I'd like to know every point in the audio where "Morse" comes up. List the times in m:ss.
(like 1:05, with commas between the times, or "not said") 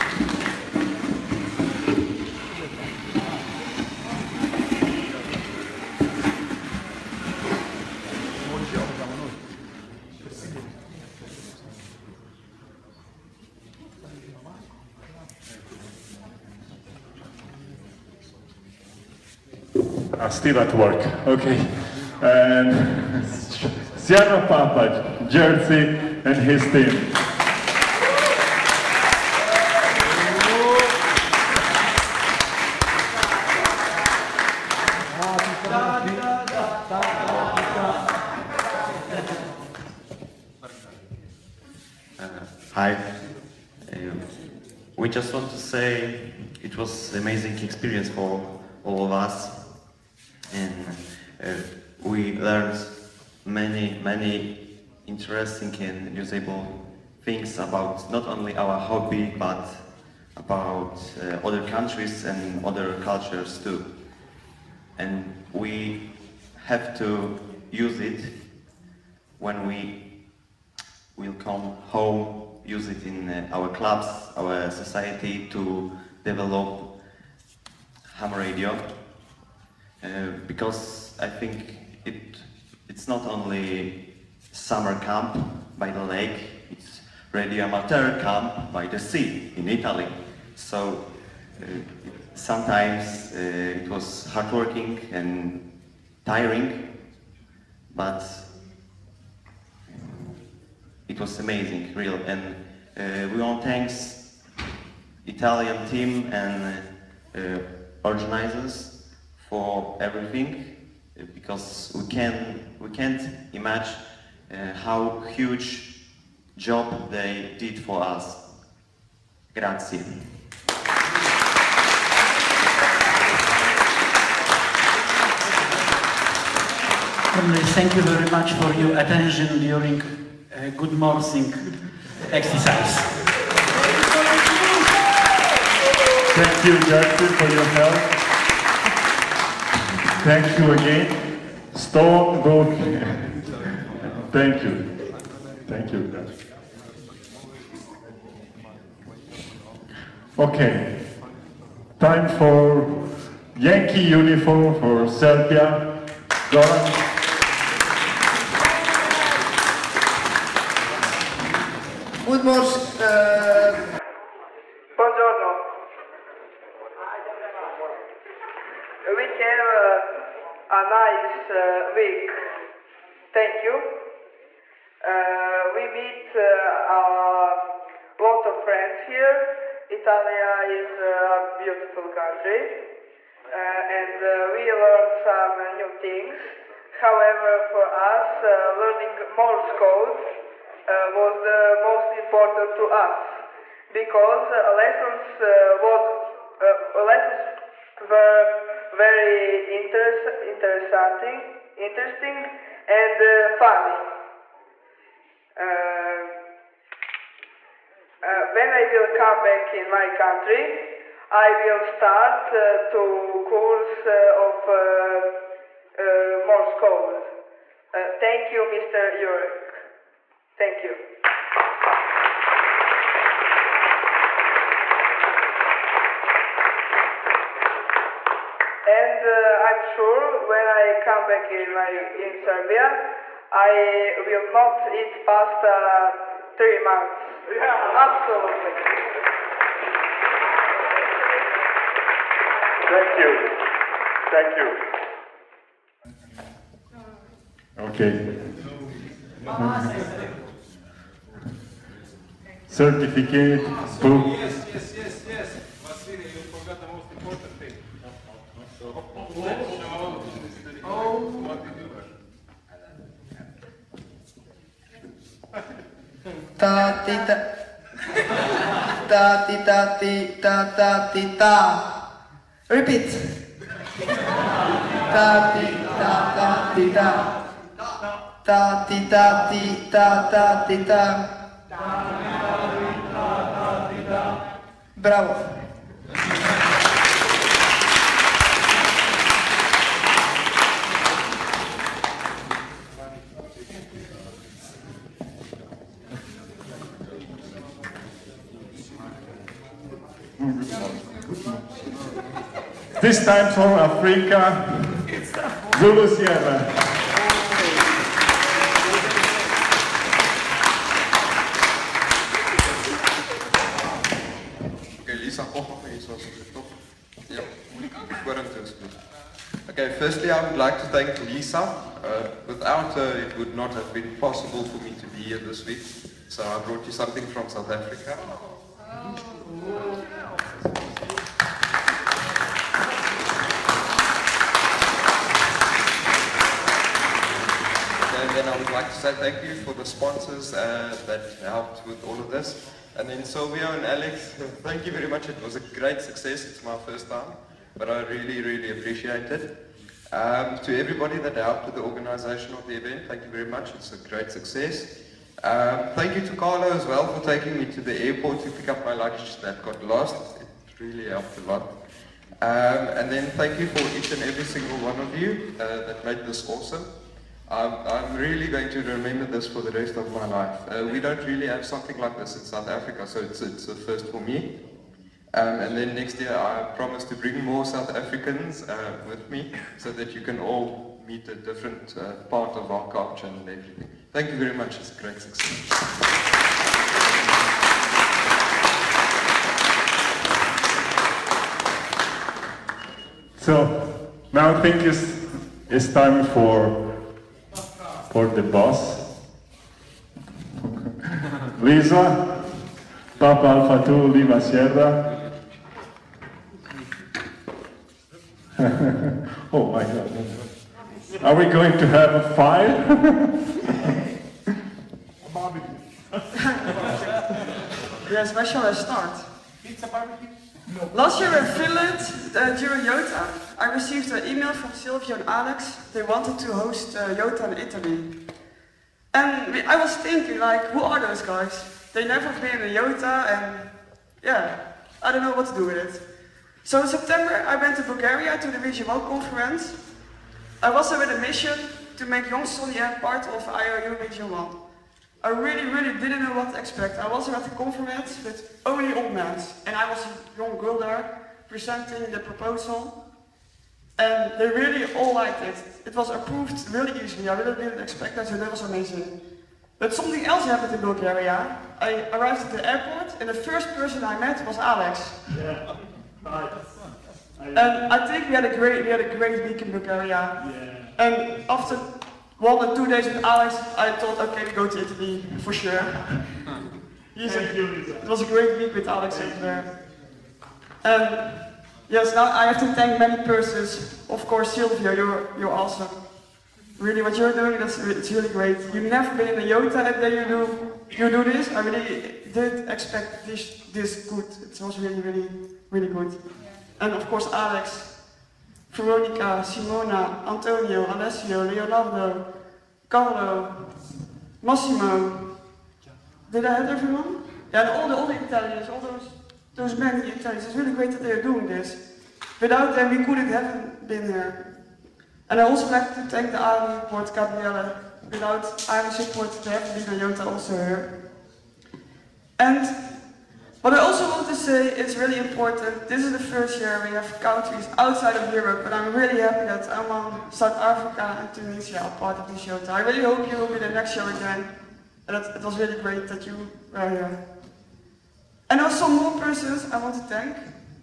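3:09, 3:36.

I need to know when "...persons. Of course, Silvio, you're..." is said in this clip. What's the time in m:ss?
8:03.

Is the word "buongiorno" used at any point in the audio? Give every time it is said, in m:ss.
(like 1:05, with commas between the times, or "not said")
2:44.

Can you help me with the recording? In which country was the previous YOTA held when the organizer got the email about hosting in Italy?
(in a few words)
Finland.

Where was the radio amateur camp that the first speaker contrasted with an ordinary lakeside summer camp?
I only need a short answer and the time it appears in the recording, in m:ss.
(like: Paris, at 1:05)
by the sea in Italy, at 1:28.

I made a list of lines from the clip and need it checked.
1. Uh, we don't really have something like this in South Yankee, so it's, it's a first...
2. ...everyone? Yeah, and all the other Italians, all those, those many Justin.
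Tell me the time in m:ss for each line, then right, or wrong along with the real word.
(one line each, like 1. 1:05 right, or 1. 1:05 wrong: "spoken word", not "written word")
1. 6:10 wrong: "Africa", not "Yankee"
2. 8:26 wrong: "Italians", not "Justin".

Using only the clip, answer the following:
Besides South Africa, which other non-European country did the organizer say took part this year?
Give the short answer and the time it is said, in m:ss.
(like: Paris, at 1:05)
Tunisia, at 8:51.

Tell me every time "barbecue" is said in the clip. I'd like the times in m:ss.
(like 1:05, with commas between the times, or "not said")
6:55, 6:59.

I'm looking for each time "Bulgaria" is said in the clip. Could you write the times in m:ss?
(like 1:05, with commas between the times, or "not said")
7:17, 7:40, 7:49.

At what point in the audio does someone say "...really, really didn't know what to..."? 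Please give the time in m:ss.
7:25.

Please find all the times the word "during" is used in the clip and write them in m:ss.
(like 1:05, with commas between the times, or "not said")
2:09, 7:02.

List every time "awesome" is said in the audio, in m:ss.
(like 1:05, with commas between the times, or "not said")
6:06, 8:05.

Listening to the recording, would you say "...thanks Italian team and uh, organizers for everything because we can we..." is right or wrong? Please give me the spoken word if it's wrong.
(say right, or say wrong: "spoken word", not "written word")
right.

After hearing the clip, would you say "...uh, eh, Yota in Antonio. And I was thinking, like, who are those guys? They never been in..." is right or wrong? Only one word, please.
wrong.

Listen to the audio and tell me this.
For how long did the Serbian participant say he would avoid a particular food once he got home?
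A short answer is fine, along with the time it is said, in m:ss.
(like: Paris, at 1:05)
3 months, at 3:56.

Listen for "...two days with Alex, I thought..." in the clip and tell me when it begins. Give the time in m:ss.
7:52.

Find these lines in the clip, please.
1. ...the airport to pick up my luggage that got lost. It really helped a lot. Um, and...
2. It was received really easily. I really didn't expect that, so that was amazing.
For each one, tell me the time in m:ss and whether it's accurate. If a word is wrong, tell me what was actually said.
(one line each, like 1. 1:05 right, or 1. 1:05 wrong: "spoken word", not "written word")
1. 5:57 right
2. 7:35 wrong: "approved", not "received".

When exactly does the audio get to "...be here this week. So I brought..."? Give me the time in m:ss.
5:25.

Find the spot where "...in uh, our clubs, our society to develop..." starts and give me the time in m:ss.
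1:13.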